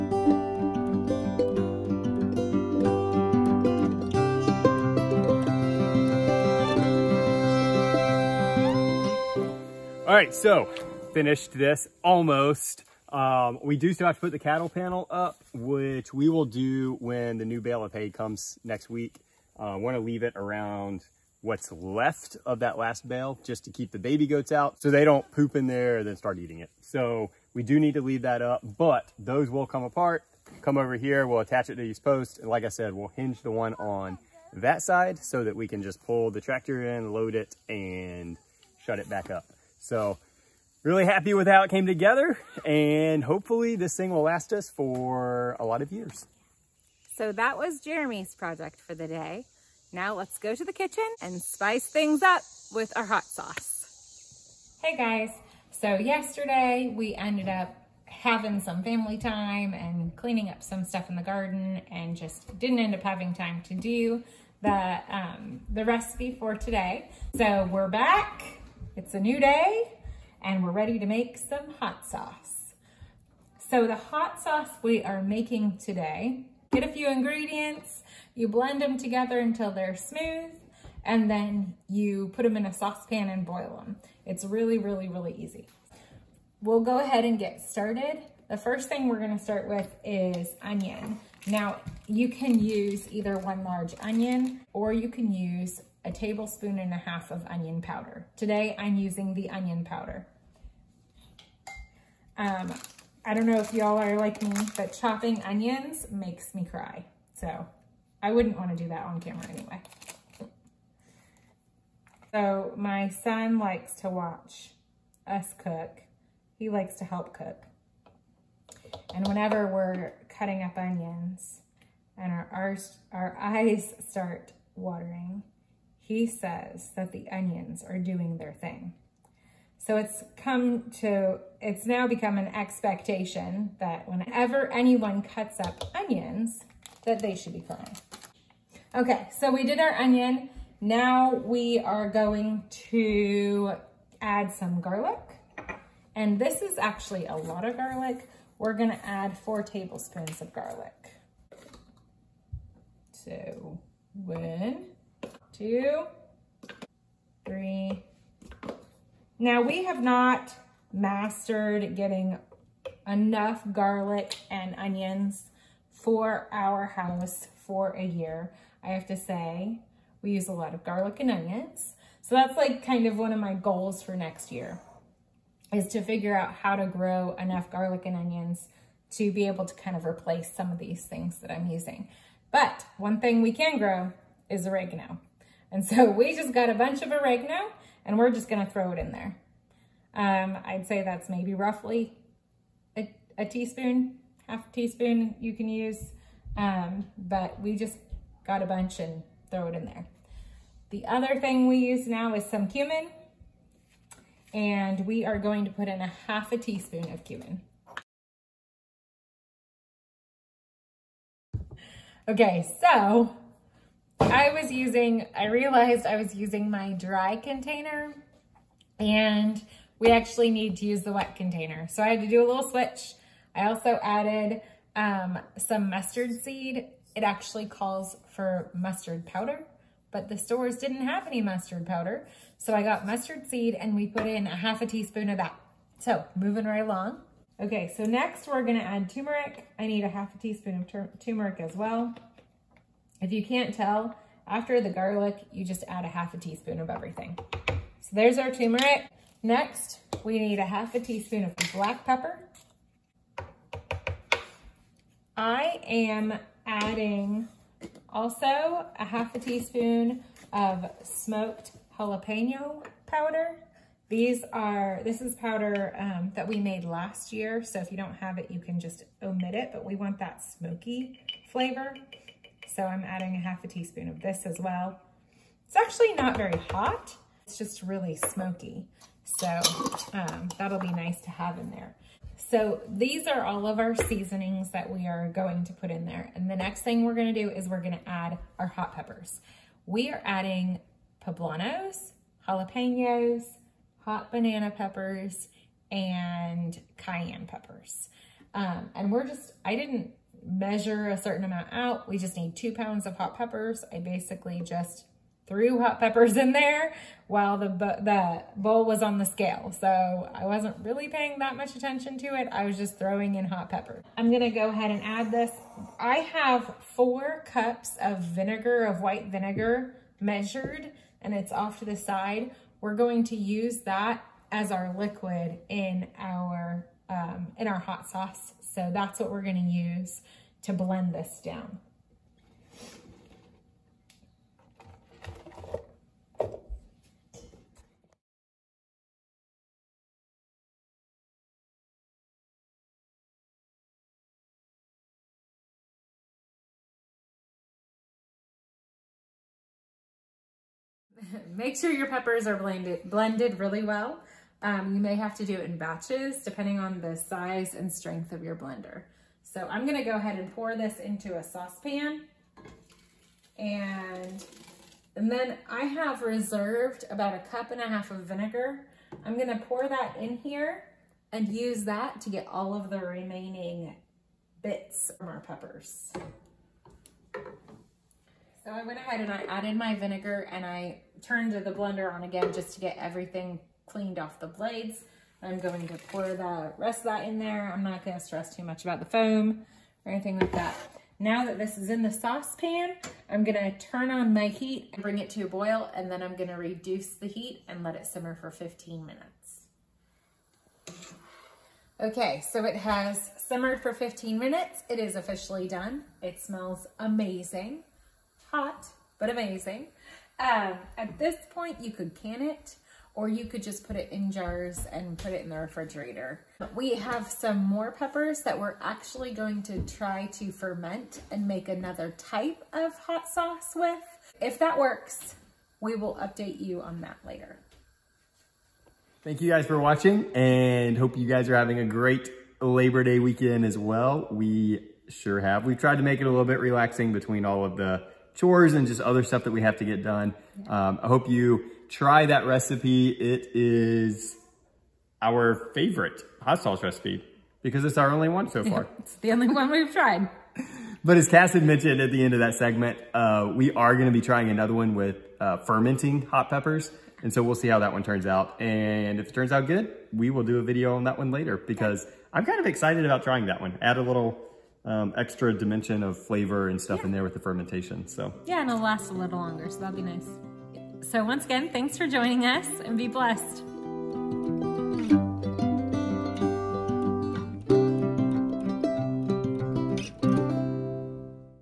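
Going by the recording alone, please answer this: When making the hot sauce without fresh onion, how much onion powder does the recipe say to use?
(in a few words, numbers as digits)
1.5 tablespoons.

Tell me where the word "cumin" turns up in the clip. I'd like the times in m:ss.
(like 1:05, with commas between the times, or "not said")
3:22, 3:27.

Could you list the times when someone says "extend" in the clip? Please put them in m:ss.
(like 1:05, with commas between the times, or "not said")
not said.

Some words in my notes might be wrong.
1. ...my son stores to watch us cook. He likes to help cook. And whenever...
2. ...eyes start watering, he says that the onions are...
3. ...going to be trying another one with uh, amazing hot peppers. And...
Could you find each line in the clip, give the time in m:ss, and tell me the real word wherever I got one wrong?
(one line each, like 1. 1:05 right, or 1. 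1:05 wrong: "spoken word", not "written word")
1. 1:52 wrong: "likes", not "stores"
2. 2:03 right
3. 7:33 wrong: "fermenting", not "amazing".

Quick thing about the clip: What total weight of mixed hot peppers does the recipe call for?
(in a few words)
2 pounds.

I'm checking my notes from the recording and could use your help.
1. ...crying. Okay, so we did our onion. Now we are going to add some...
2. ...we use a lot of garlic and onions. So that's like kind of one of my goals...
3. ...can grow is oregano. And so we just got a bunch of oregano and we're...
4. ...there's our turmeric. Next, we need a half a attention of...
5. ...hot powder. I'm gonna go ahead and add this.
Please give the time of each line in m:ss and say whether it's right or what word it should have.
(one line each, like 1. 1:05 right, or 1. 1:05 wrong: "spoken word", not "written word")
1. 2:17 right
2. 2:50 right
3. 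3:03 right
4. 4:08 wrong: "teaspoon", not "attention"
5. 5:13 wrong: "pepper", not "powder".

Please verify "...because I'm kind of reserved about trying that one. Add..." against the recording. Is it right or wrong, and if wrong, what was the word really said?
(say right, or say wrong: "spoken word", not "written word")
wrong: "excited", not "reserved".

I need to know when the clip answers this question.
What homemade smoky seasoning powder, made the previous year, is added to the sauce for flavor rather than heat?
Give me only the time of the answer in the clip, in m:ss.
4:21.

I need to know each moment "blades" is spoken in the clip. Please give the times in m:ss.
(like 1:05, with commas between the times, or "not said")
6:24.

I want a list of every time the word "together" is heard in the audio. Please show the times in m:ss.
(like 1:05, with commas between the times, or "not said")
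0:41, 1:18.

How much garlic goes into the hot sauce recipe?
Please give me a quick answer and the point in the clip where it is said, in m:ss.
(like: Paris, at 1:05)
4 tablespoons, at 2:29.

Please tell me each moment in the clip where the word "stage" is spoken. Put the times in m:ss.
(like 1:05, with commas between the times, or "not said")
not said.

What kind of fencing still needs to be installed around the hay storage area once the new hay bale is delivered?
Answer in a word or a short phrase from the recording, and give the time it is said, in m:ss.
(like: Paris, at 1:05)
cattle panel, at 0:14.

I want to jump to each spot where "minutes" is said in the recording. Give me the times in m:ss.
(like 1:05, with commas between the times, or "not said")
6:39, 6:44.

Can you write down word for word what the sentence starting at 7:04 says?
If that works, we will update you on that later.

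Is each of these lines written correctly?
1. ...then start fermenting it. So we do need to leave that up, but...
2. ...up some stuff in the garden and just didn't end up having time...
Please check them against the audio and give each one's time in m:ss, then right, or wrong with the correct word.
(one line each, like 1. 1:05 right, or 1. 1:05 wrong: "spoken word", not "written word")
1. 0:26 wrong: "eating", not "fermenting"
2. 1:00 right.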